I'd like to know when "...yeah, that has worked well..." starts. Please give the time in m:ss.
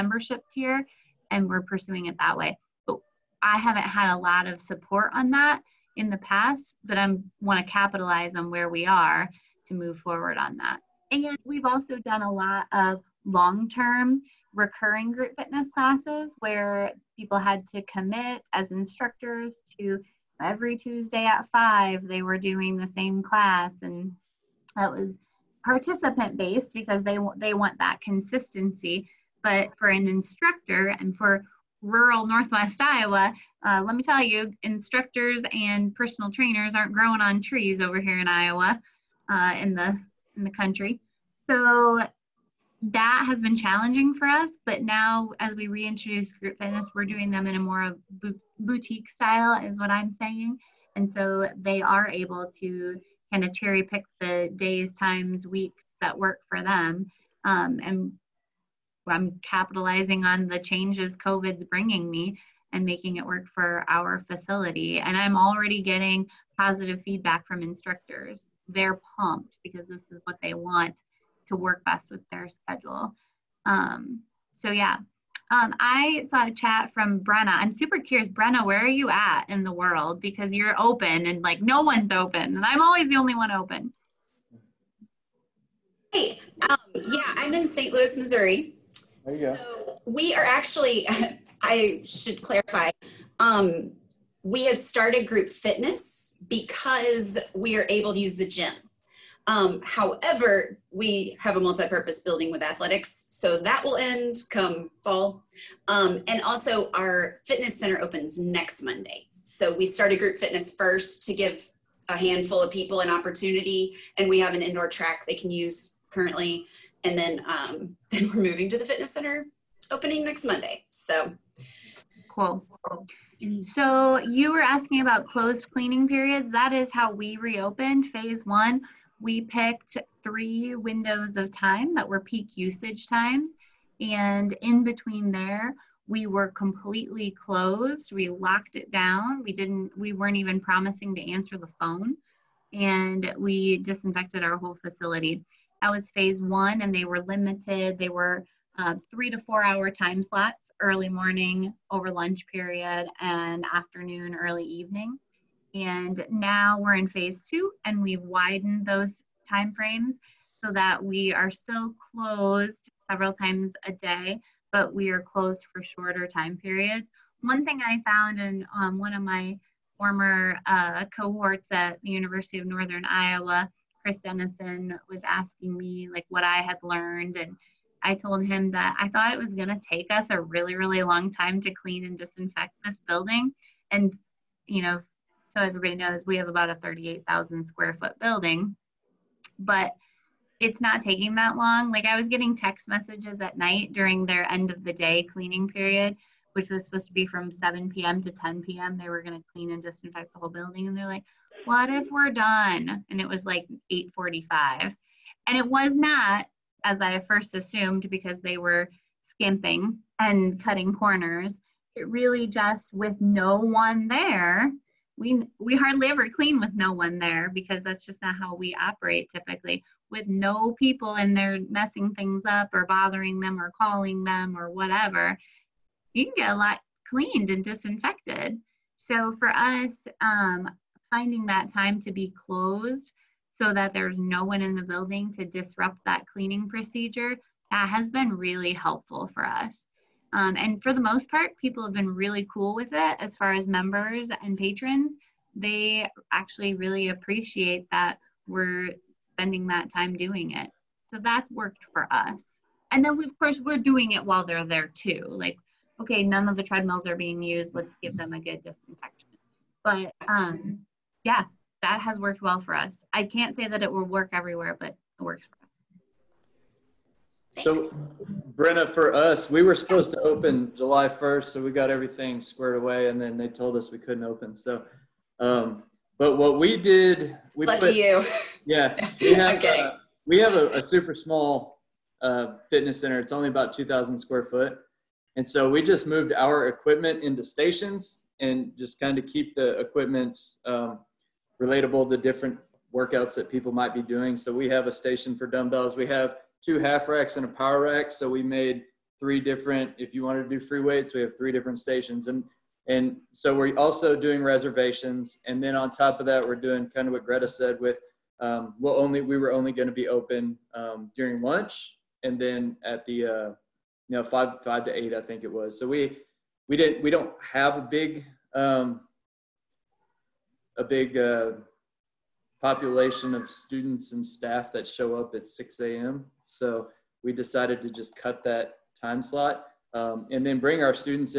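4:21.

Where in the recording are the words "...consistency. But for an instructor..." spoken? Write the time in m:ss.
0:28.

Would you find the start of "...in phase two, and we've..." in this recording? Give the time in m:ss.
2:36.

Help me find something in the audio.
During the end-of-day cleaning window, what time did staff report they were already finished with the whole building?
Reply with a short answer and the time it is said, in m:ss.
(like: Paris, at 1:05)
8:45, at 3:23.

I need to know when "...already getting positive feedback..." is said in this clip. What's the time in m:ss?
1:05.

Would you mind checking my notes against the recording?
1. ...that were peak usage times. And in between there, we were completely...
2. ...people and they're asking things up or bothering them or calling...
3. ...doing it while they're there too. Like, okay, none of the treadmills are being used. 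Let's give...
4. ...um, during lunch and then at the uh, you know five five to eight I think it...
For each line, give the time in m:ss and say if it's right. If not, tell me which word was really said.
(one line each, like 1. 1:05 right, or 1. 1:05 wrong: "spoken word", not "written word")
1. 2:11 right
2. 3:40 wrong: "messing", not "asking"
3. 4:13 right
4. 5:10 right.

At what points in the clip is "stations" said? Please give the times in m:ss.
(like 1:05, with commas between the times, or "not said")
4:47, 4:54, 5:01.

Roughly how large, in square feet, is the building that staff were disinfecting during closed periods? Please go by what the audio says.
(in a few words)
38,000 square feet.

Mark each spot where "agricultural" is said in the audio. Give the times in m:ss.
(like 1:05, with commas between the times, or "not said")
not said.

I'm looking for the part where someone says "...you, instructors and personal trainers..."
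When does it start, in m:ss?
0:34.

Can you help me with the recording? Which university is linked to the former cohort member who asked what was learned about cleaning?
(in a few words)
University of Northern Iowa.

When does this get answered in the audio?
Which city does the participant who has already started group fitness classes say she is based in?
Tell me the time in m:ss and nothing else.
1:27.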